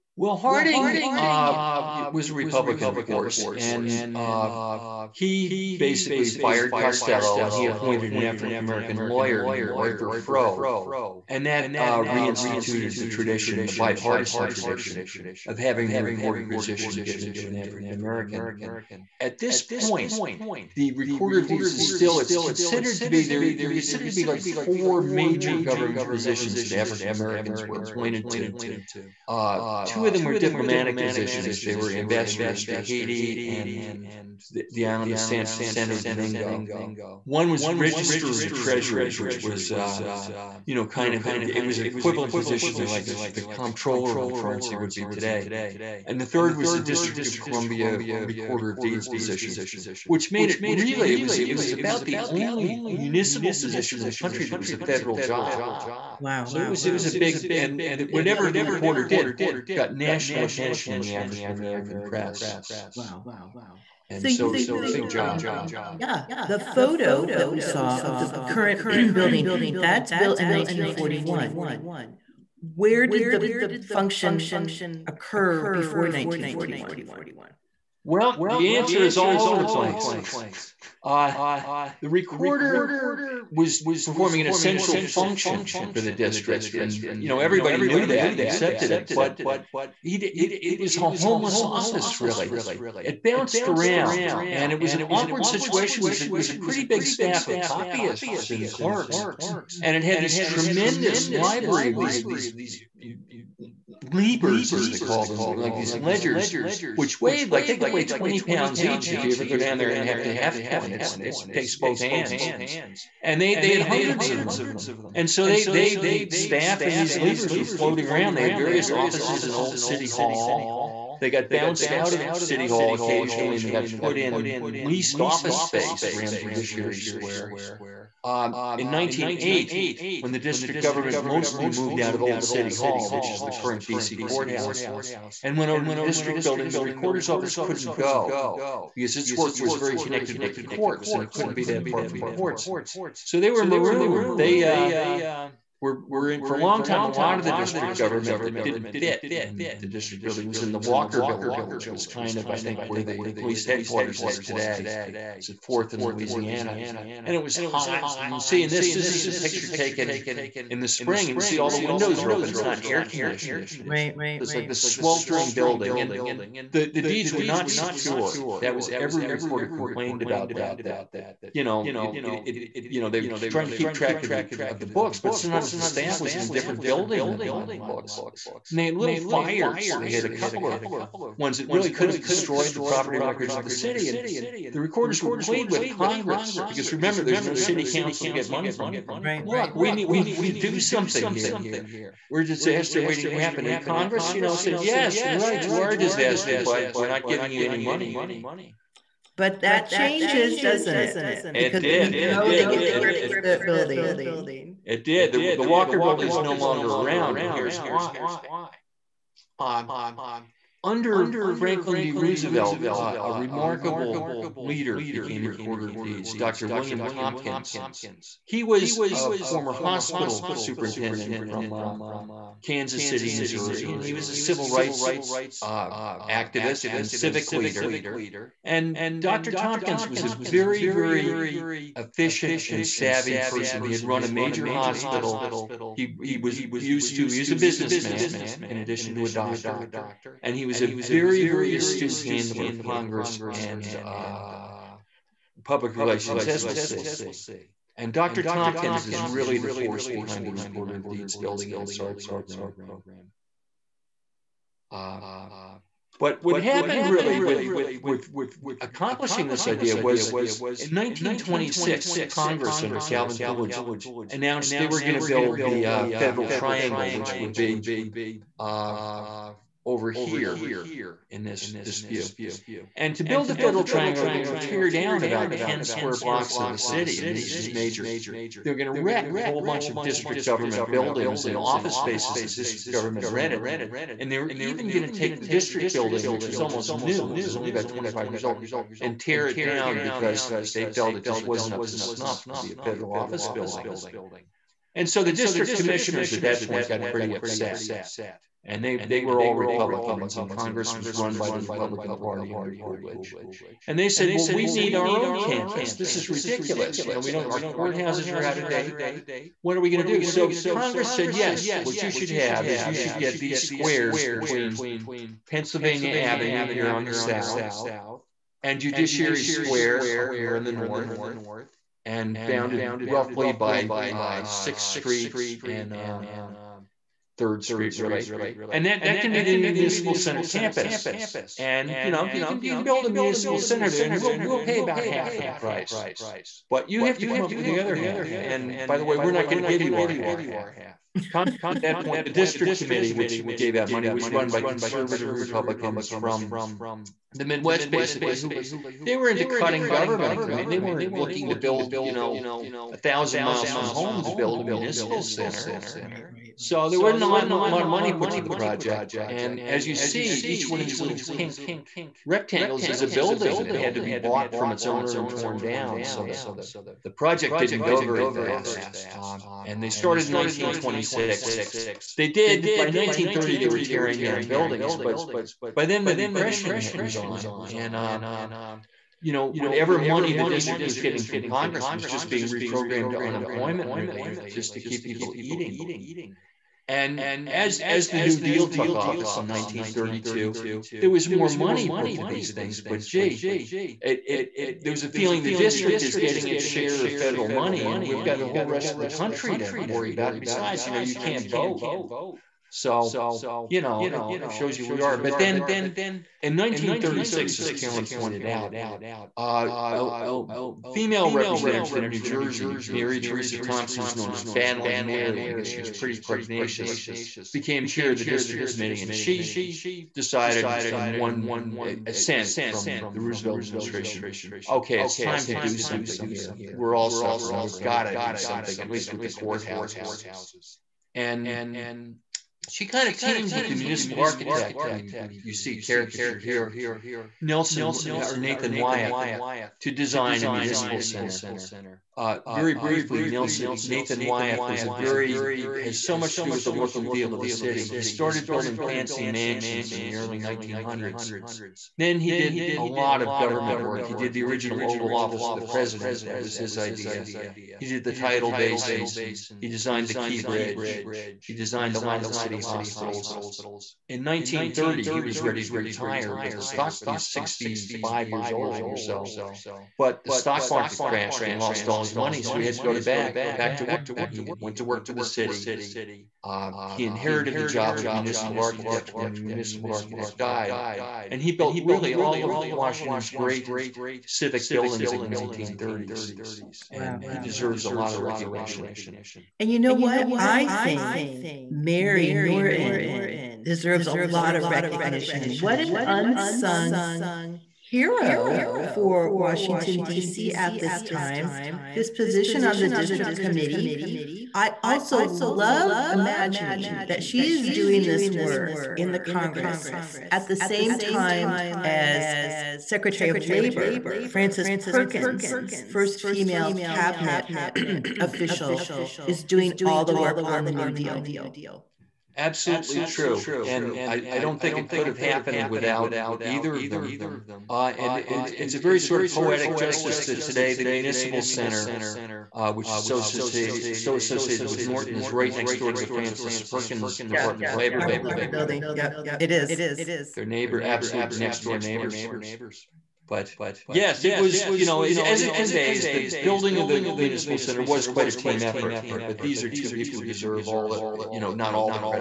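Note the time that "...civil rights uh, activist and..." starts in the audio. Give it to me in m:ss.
3:44.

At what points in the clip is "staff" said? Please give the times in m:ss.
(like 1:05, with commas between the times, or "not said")
1:37, 1:56, 2:55.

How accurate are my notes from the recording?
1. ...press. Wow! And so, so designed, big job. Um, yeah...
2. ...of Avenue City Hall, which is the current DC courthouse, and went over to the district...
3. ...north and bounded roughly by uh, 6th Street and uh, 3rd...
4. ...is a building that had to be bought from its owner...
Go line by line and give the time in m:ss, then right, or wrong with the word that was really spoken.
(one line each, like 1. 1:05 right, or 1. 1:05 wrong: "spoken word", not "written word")
1. 1:02 wrong: "showed", not "designed"
2. 2:12 wrong: "Old", not "Avenue"
3. 5:20 right
4. 6:02 right.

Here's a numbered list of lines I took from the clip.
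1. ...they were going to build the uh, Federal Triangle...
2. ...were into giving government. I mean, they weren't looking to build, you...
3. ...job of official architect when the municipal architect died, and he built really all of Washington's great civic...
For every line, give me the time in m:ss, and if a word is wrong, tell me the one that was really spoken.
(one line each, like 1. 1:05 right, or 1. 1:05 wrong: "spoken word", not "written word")
1. 4:24 right
2. 5:49 wrong: "cutting", not "giving"
3. 7:57 wrong: "municipal", not "official".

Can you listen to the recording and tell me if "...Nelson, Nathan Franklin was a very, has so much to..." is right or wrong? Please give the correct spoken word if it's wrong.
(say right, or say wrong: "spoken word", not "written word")
wrong: "Wyeth", not "Franklin".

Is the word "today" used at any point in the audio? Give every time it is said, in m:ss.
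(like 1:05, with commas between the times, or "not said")
0:45, 2:34, 8:50.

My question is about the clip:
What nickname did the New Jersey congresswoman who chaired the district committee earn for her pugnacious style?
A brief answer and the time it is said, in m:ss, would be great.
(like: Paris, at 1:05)
Battling Mary, at 6:54.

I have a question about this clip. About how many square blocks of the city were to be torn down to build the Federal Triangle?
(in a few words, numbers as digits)
10.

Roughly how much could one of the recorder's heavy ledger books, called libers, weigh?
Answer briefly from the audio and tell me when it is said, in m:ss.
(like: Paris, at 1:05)
20 pounds, at 1:48.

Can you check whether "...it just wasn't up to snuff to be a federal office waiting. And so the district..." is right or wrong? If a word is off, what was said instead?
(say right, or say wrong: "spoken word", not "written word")
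wrong: "building", not "waiting".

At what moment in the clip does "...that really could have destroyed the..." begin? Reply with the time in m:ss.
3:01.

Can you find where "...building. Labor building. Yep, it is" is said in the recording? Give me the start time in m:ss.
8:58.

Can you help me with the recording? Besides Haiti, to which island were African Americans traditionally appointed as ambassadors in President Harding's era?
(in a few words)
Santo Domingo.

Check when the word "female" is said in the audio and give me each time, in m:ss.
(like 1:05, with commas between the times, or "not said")
6:50, 8:36.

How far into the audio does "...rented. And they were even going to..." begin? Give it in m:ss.
4:43.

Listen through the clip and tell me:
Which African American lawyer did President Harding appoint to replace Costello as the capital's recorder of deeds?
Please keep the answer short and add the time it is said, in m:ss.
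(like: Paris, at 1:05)
Arthur Froe, at 0:09.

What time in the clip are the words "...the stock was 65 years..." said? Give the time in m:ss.
7:46.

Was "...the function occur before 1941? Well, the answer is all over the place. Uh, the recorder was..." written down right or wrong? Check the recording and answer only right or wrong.
right.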